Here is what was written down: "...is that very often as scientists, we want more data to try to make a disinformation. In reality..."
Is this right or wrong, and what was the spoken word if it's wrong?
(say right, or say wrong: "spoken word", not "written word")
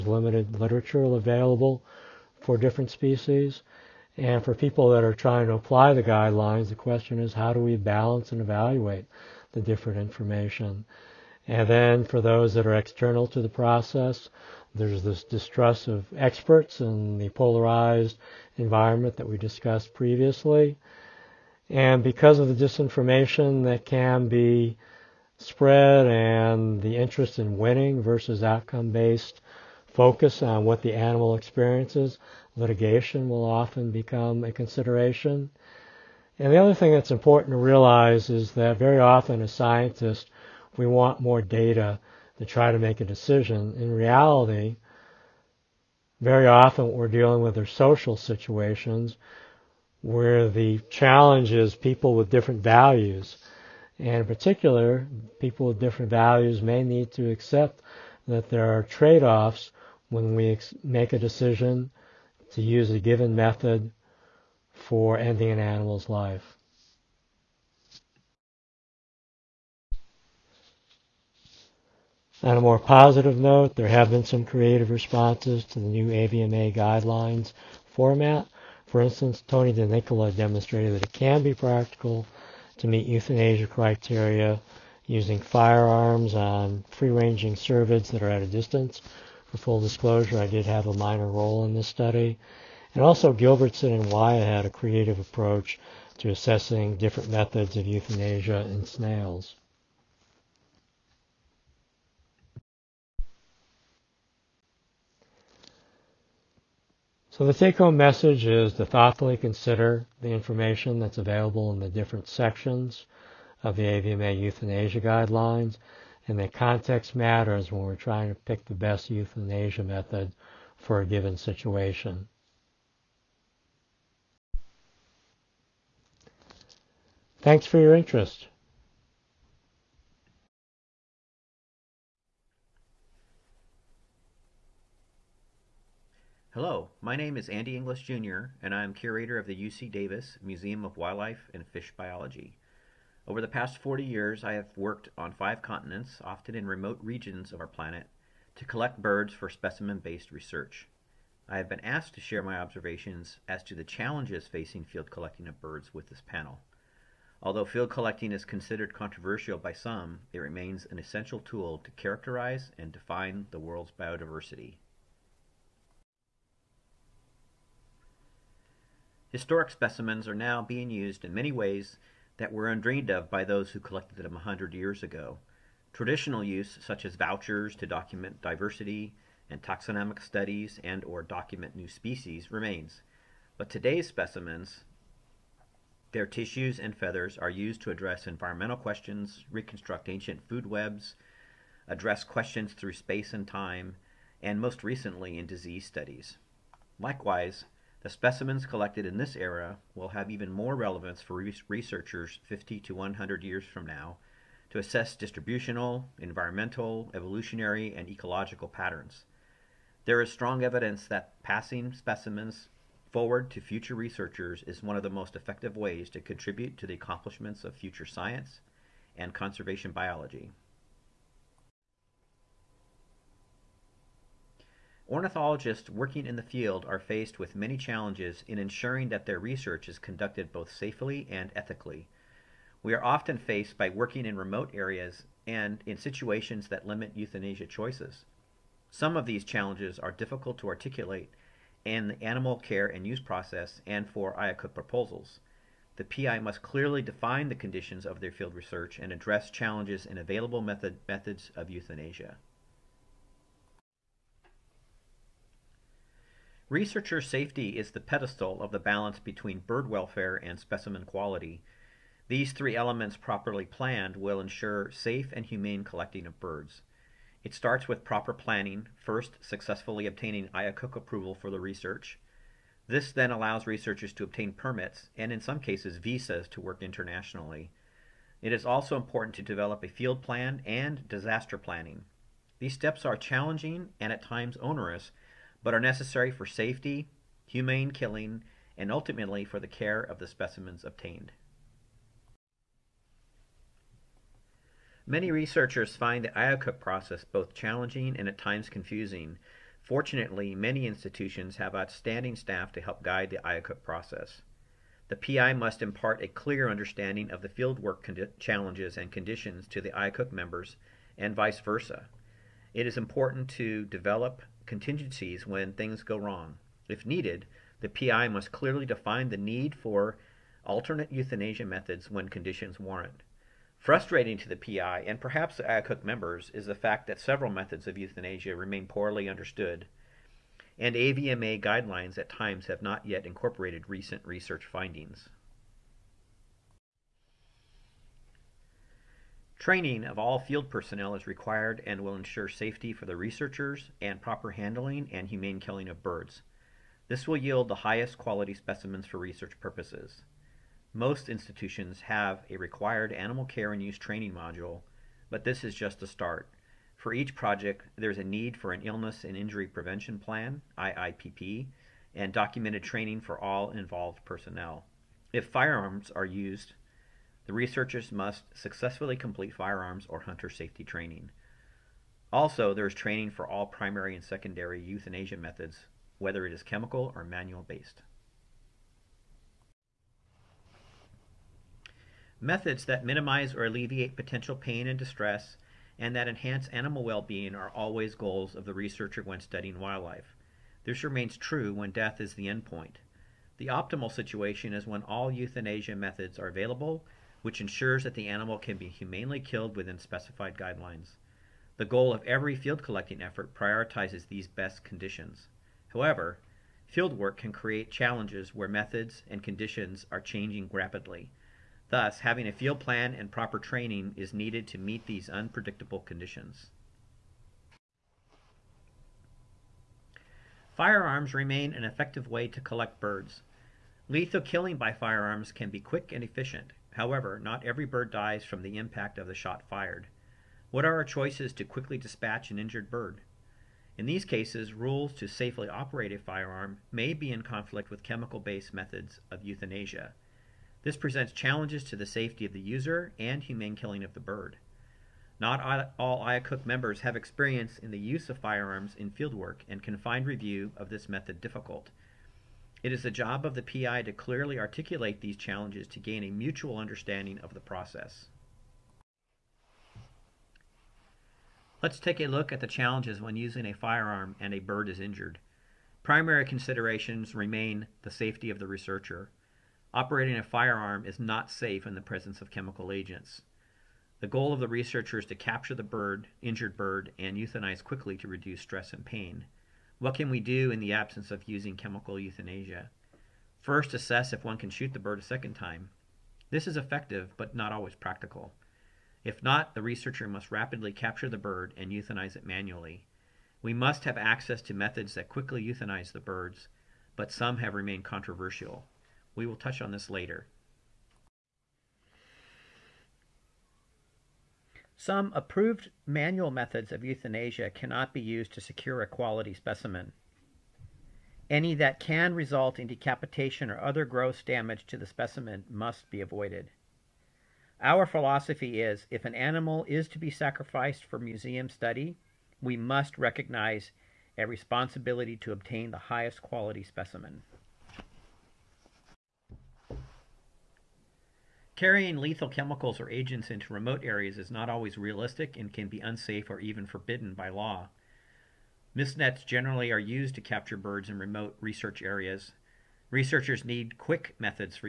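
wrong: "decision", not "disinformation".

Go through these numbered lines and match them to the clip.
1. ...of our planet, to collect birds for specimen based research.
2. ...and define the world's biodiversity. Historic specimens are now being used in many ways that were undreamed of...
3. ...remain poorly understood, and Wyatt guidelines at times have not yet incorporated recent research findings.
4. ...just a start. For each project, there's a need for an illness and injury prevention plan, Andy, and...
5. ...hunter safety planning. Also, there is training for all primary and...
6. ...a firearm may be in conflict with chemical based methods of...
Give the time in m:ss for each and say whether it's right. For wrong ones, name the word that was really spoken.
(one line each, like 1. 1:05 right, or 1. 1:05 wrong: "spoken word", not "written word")
1. 2:27 right
2. 2:42 right
3. 5:28 wrong: "AVMA", not "Wyatt"
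4. 5:55 wrong: "IIPP", not "Andy"
5. 6:10 wrong: "training", not "planning"
6. 7:16 right.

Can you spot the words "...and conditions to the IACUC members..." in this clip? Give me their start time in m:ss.
5:08.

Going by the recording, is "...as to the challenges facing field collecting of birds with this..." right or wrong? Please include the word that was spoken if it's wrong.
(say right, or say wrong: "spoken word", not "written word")
right.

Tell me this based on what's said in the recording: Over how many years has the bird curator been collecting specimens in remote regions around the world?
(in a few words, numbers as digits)
40 years.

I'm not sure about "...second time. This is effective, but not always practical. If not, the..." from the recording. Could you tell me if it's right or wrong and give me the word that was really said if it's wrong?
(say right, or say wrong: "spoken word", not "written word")
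right.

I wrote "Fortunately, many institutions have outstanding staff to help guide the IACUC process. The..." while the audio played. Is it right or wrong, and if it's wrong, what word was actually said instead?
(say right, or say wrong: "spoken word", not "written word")
right.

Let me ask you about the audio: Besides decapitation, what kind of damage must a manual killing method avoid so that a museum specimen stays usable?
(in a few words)
gross damage.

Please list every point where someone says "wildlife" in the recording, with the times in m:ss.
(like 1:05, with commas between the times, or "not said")
2:20, 6:29.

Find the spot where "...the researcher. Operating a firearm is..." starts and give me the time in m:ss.
7:48.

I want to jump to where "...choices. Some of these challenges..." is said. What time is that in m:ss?
3:57.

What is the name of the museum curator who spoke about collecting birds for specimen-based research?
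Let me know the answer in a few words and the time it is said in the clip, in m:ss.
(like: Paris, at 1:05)
Andy Engilis Jr., at 2:17.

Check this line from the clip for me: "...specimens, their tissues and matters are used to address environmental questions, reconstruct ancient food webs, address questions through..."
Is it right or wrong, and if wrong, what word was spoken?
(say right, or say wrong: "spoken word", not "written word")
wrong: "feathers", not "matters".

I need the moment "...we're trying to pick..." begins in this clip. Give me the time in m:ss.
1:57.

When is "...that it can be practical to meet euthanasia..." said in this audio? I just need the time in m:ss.
1:20.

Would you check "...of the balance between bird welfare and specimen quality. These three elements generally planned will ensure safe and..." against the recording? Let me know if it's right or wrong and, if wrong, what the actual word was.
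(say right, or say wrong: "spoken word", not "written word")
wrong: "properly", not "generally".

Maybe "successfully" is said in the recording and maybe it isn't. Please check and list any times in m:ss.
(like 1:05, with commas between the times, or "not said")
4:29, 6:08.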